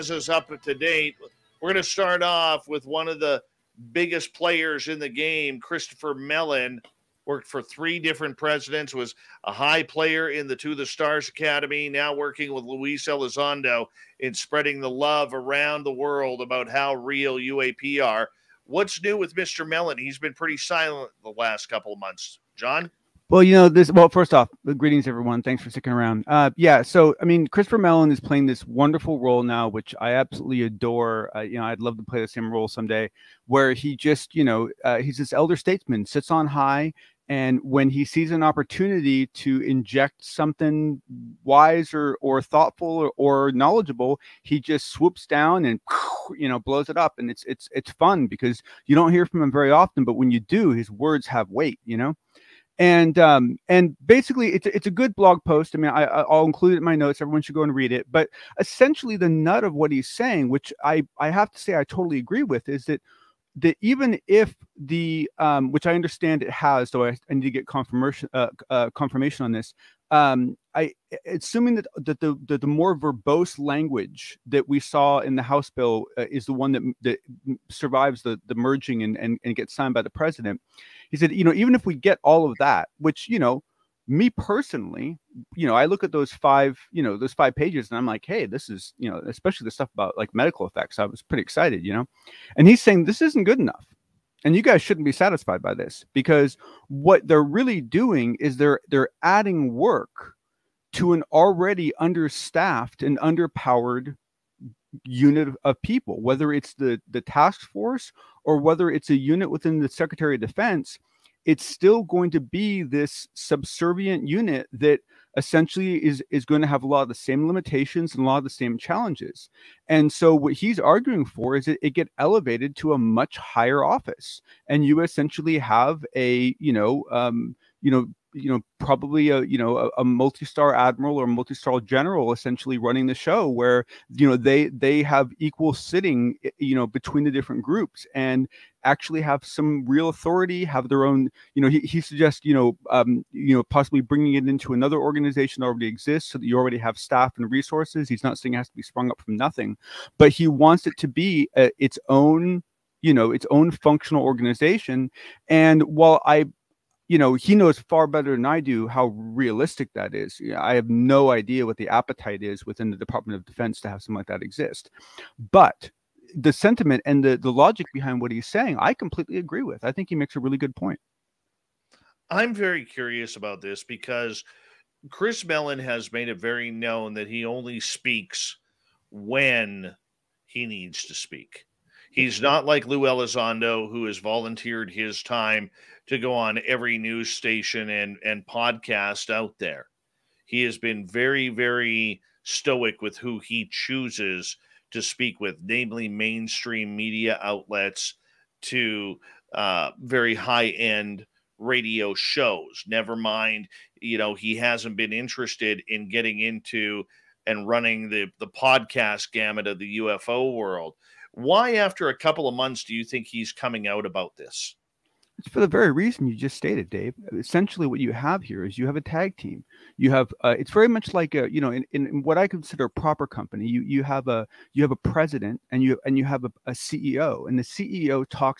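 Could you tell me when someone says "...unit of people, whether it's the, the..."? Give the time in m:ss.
1:45.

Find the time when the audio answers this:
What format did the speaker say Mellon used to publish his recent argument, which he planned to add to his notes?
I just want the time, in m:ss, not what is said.
0:55.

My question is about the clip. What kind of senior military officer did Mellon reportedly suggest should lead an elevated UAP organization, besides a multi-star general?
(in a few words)
Multi-star admiral.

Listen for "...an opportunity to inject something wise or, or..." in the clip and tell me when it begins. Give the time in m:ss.
0:38.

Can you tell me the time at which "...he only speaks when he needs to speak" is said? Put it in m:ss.
2:57.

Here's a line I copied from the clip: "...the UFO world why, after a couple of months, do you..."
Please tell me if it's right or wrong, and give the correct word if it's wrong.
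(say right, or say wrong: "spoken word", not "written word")
right.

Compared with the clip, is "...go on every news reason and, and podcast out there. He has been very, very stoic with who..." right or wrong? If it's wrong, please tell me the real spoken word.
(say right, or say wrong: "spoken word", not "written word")
wrong: "station", not "reason".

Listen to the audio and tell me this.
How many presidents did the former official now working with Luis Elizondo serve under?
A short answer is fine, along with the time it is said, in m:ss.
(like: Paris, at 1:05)
3, at 0:07.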